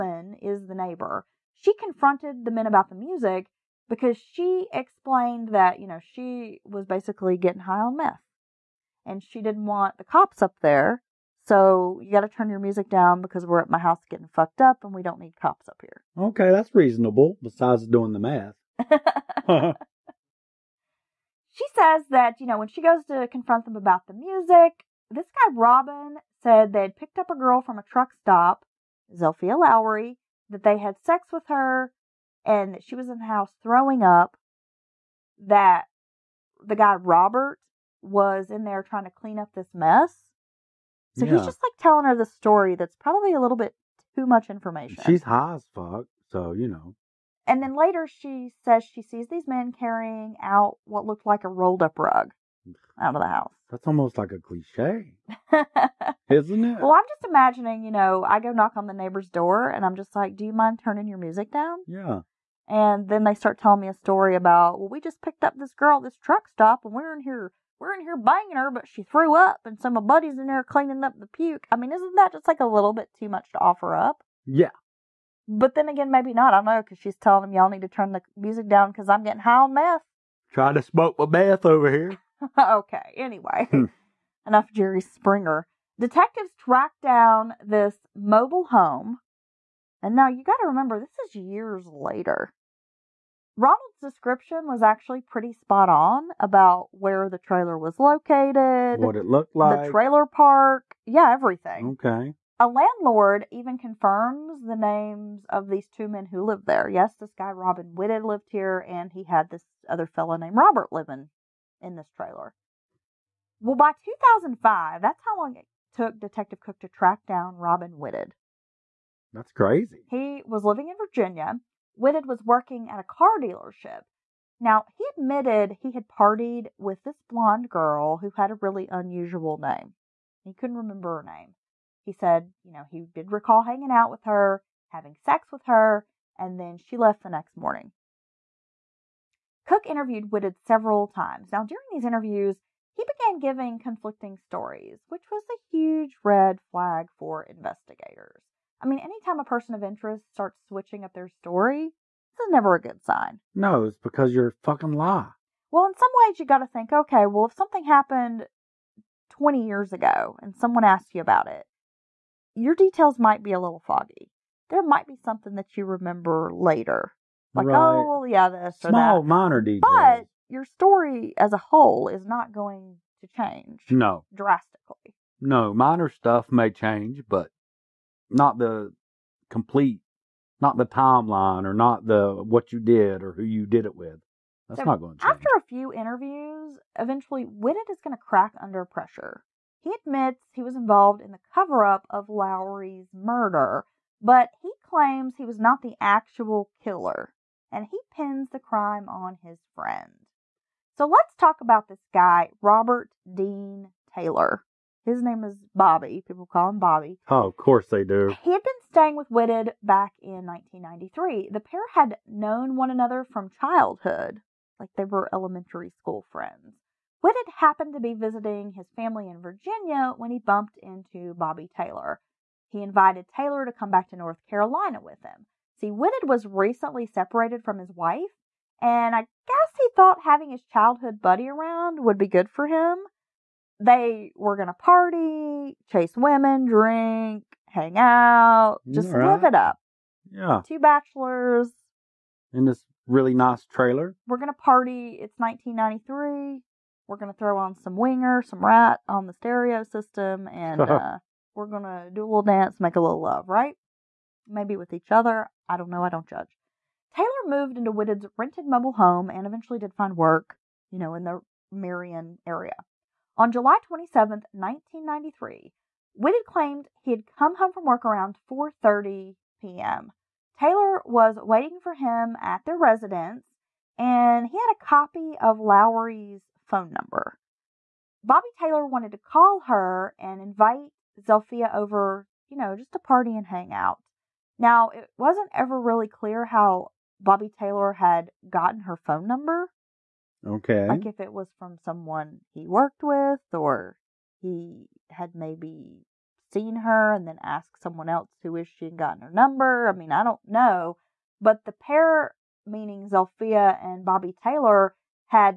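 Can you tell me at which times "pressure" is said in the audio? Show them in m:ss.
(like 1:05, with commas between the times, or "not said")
3:08.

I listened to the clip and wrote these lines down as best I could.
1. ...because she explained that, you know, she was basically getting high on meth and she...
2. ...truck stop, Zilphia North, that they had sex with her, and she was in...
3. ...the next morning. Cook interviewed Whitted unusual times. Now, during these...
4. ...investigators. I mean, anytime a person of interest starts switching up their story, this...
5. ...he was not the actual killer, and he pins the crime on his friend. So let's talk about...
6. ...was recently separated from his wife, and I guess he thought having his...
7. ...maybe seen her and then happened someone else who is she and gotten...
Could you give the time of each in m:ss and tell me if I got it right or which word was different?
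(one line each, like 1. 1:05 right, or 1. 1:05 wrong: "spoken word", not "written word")
1. 0:03 right
2. 0:27 wrong: "Lowery", not "North"
3. 2:17 wrong: "several", not "unusual"
4. 2:27 right
5. 3:15 right
6. 3:46 right
7. 4:55 wrong: "asked", not "happened".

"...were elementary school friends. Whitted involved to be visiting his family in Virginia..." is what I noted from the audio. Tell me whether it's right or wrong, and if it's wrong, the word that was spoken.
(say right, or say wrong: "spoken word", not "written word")
wrong: "happened", not "involved".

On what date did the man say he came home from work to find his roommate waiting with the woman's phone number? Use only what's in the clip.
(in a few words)
July 27, 1993.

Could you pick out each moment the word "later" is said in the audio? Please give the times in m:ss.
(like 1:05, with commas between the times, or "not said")
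0:47, 1:31, 2:46.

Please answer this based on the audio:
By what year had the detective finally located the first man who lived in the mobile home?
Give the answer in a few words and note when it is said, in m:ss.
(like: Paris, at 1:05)
2005, at 1:54.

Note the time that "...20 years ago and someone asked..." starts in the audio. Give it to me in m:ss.
2:39.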